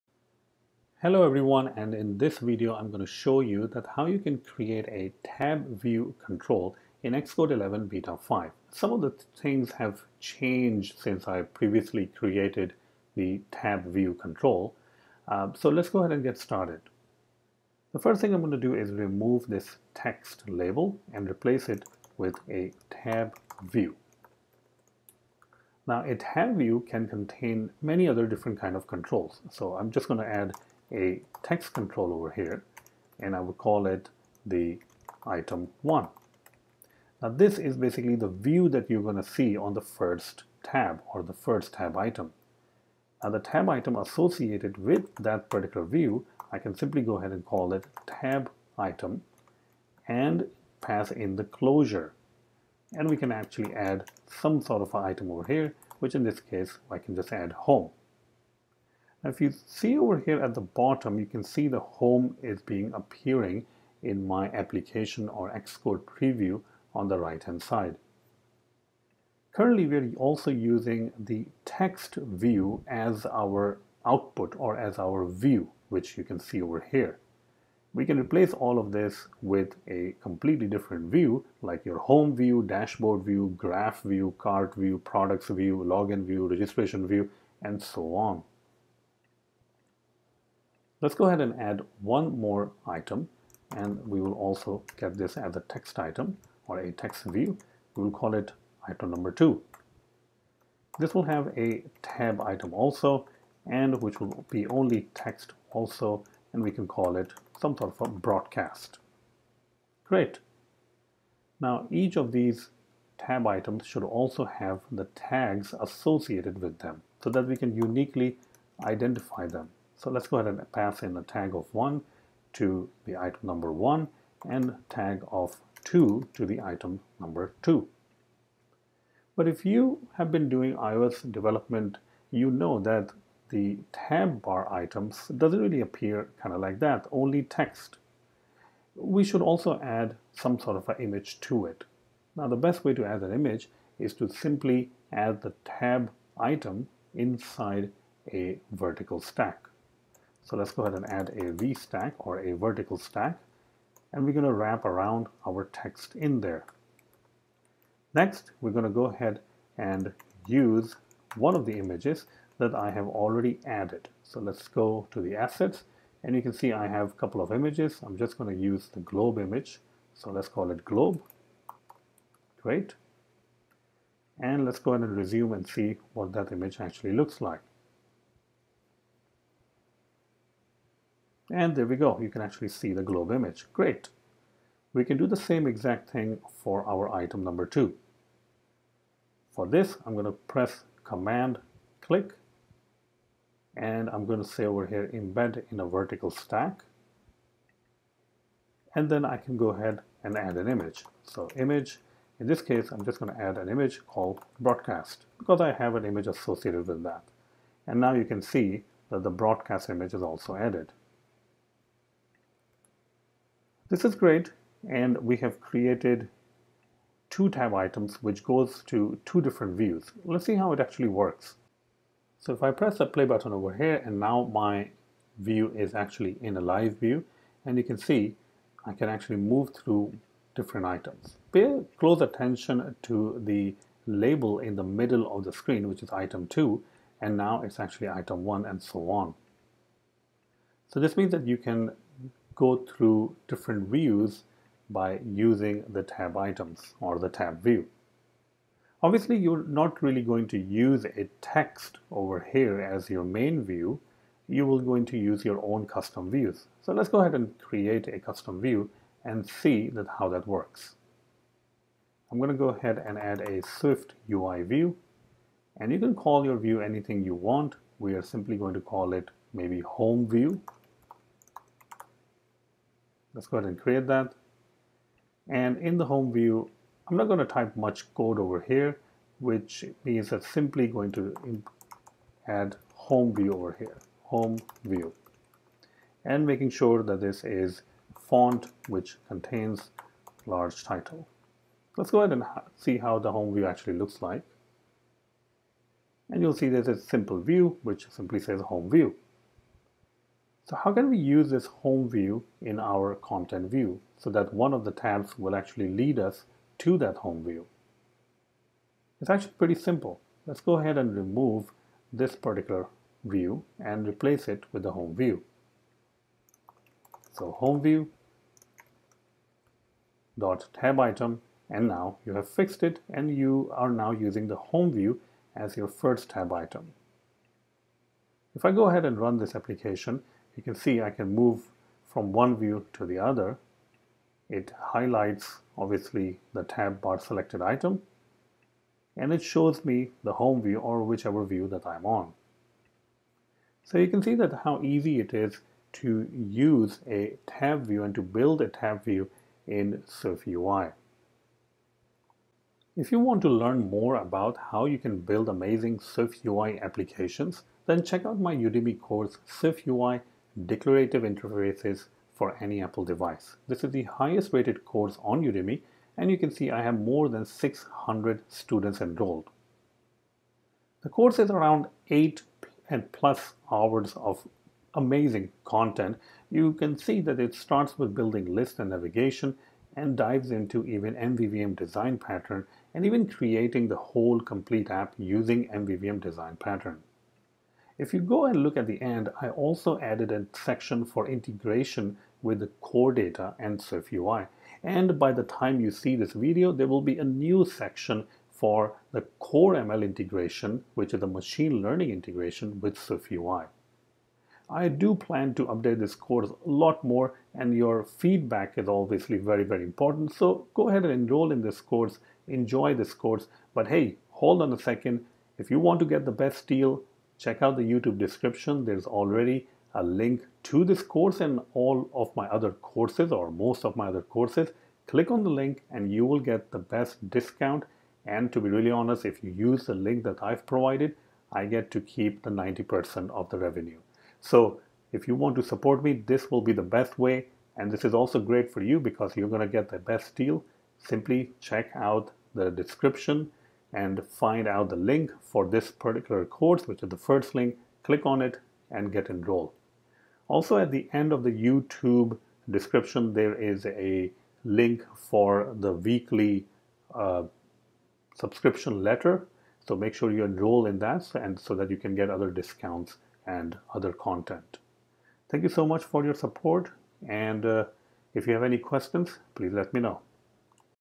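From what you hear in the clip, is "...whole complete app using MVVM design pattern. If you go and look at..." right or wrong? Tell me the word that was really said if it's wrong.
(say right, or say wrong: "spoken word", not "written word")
right.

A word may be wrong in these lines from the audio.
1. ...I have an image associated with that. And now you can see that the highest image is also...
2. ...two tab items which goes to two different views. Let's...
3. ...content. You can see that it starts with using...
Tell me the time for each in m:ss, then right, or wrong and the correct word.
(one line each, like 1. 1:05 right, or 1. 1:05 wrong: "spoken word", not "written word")
1. 3:25 wrong: "broadcast", not "highest"
2. 3:37 right
3. 6:15 wrong: "building", not "using".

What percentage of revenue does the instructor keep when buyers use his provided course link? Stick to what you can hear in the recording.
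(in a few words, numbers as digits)
90%.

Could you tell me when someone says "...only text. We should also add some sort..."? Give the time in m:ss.
2:17.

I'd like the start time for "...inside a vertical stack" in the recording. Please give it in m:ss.
2:27.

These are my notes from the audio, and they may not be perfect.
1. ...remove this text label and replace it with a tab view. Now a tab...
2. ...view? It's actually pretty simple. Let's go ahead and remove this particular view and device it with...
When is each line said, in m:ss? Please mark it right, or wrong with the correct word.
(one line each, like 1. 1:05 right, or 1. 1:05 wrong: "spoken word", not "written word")
1. 0:18 right
2. 5:07 wrong: "replace", not "device".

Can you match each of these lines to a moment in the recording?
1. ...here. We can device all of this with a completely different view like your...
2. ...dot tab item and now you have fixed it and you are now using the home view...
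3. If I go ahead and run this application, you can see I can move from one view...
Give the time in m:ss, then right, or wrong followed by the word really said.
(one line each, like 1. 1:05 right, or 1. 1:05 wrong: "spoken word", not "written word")
1. 1:16 wrong: "replace", not "device"
2. 5:20 right
3. 5:28 right.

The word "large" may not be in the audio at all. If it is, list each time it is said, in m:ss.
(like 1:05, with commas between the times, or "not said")
4:50.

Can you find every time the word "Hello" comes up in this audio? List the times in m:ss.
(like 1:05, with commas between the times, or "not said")
0:01.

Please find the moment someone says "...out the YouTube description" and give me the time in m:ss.
6:57.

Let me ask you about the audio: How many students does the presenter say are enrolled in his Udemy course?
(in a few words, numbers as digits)
more than 600.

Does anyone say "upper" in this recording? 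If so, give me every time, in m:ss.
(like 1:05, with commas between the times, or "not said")
not said.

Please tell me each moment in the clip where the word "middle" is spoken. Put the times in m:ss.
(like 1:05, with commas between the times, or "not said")
3:54.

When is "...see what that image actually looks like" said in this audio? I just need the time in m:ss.
2:55.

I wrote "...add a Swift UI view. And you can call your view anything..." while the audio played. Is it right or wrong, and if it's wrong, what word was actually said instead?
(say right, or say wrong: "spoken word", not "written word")
right.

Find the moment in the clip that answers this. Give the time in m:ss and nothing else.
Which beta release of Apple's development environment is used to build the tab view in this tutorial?
0:07.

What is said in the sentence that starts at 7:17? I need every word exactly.
And this is also great for you because you're going to get the best deal.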